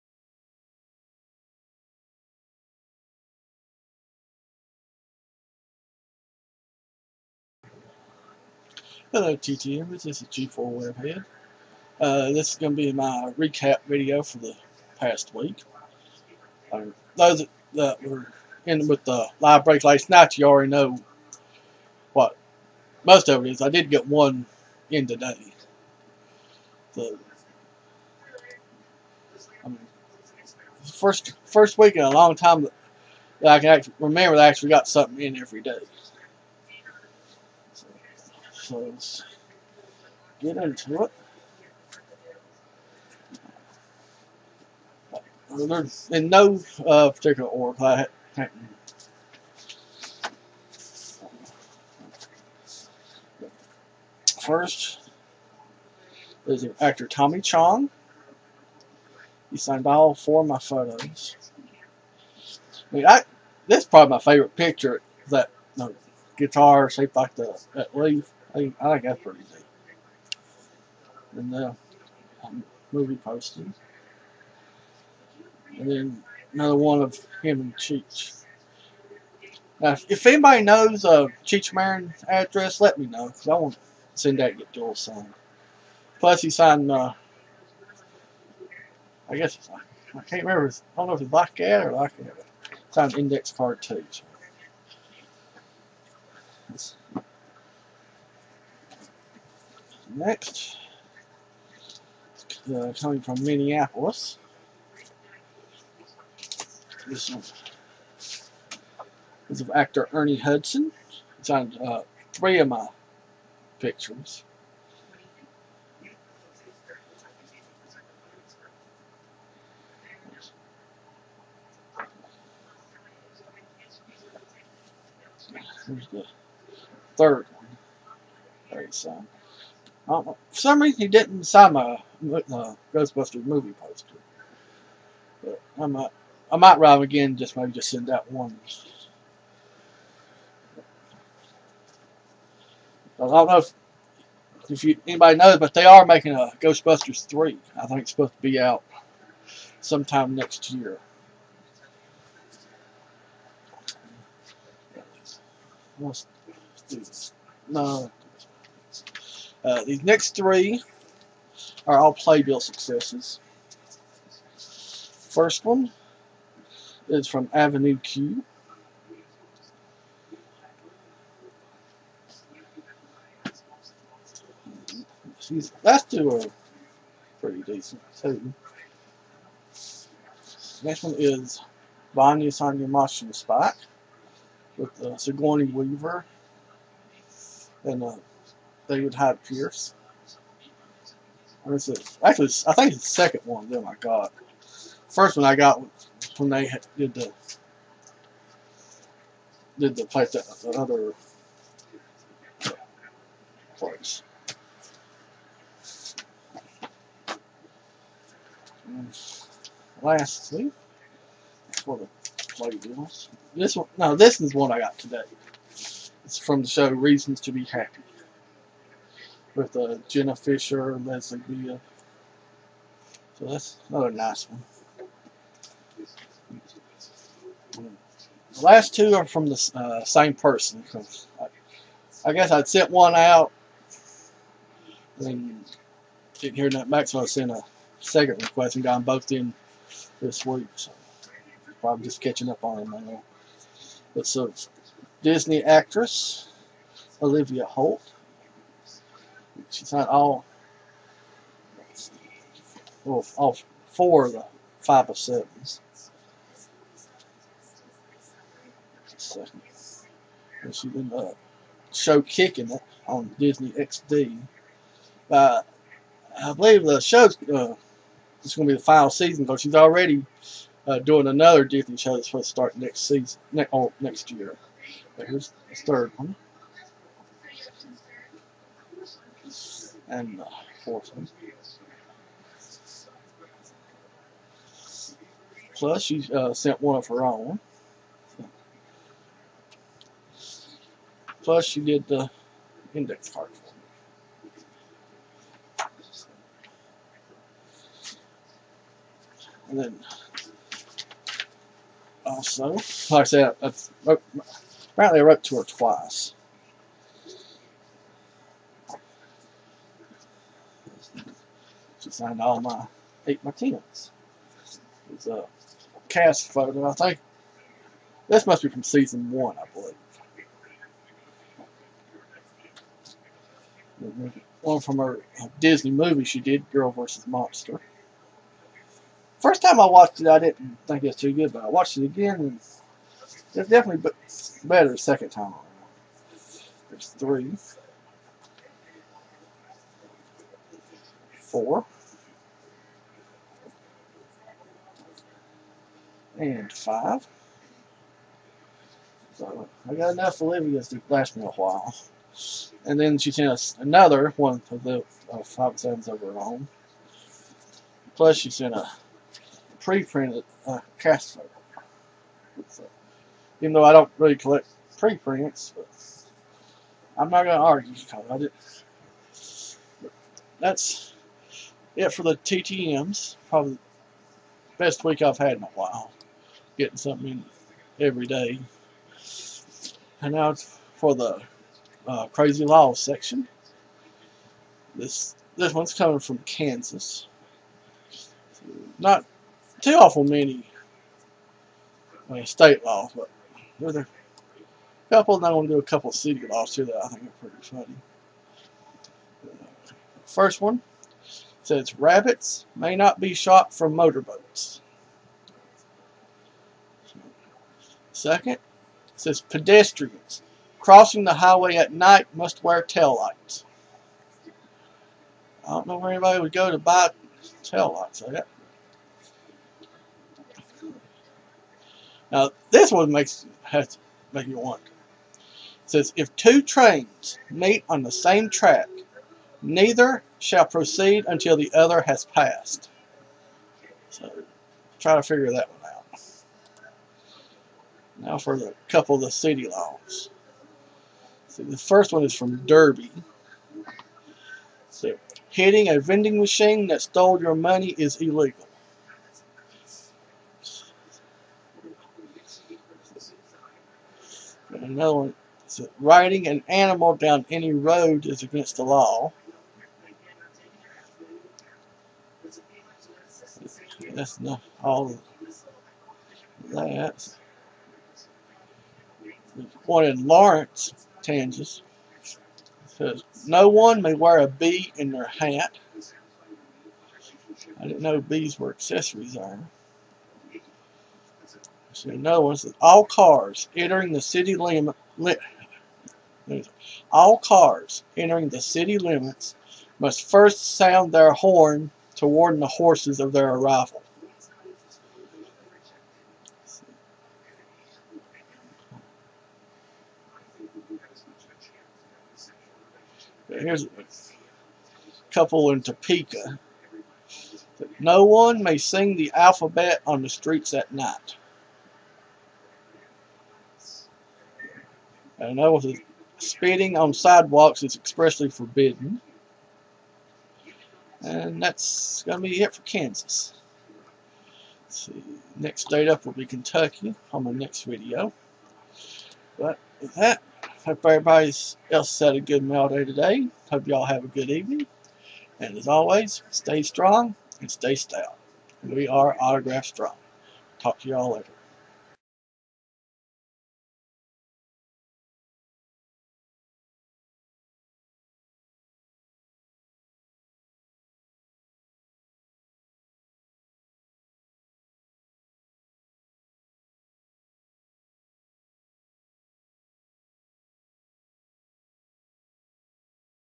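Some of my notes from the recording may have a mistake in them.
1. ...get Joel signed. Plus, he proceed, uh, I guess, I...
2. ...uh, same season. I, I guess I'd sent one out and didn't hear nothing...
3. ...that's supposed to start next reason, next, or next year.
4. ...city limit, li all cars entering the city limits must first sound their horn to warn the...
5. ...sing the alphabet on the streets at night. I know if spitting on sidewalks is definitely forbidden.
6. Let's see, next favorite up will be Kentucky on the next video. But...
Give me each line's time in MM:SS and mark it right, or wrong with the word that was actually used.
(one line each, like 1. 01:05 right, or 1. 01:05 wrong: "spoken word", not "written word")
1. 01:24 wrong: "signed", not "proceed"
2. 03:49 wrong: "person", not "season"
3. 04:32 wrong: "season", not "reason"
4. 08:04 right
5. 08:28 wrong: "expressly", not "definitely"
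6. 08:44 wrong: "state", not "favorite".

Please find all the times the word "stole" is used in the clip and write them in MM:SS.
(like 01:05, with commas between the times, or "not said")
07:27.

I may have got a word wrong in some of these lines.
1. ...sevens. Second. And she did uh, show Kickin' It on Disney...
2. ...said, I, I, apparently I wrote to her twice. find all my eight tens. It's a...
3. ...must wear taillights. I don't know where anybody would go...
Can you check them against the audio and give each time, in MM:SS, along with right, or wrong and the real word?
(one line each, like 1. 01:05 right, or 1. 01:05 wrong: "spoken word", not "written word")
1. 04:15 right
2. 05:03 right
3. 06:52 right.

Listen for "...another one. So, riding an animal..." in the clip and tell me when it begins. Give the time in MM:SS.
07:34.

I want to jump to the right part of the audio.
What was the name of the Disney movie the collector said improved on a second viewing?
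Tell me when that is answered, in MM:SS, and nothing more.
05:26.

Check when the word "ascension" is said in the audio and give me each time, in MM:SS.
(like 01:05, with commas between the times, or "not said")
not said.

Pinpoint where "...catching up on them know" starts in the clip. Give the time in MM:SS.
04:02.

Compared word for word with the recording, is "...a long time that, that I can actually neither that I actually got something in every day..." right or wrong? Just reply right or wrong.
wrong.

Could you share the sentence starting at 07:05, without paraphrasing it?
It says if two trains meet on the same track, neither shall proceed until the other has passed.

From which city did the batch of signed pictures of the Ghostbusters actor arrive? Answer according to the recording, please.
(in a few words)
Minneapolis.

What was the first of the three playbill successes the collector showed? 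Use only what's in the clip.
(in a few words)
Avenue Q.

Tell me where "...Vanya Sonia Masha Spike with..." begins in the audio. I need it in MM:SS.
03:02.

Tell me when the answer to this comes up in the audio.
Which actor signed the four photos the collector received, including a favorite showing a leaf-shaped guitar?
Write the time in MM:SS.
00:57.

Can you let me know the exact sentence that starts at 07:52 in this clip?
Says, no one may wear a bee in their hat.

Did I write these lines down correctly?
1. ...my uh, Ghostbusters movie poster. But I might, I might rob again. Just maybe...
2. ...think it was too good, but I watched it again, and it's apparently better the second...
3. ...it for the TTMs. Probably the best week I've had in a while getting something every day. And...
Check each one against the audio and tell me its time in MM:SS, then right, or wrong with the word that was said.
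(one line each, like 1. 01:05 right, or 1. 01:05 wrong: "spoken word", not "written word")
1. 02:11 right
2. 05:30 wrong: "definitely", not "apparently"
3. 06:11 right.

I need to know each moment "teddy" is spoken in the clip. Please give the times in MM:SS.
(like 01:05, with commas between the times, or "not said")
not said.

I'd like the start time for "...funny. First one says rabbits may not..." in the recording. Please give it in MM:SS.
06:37.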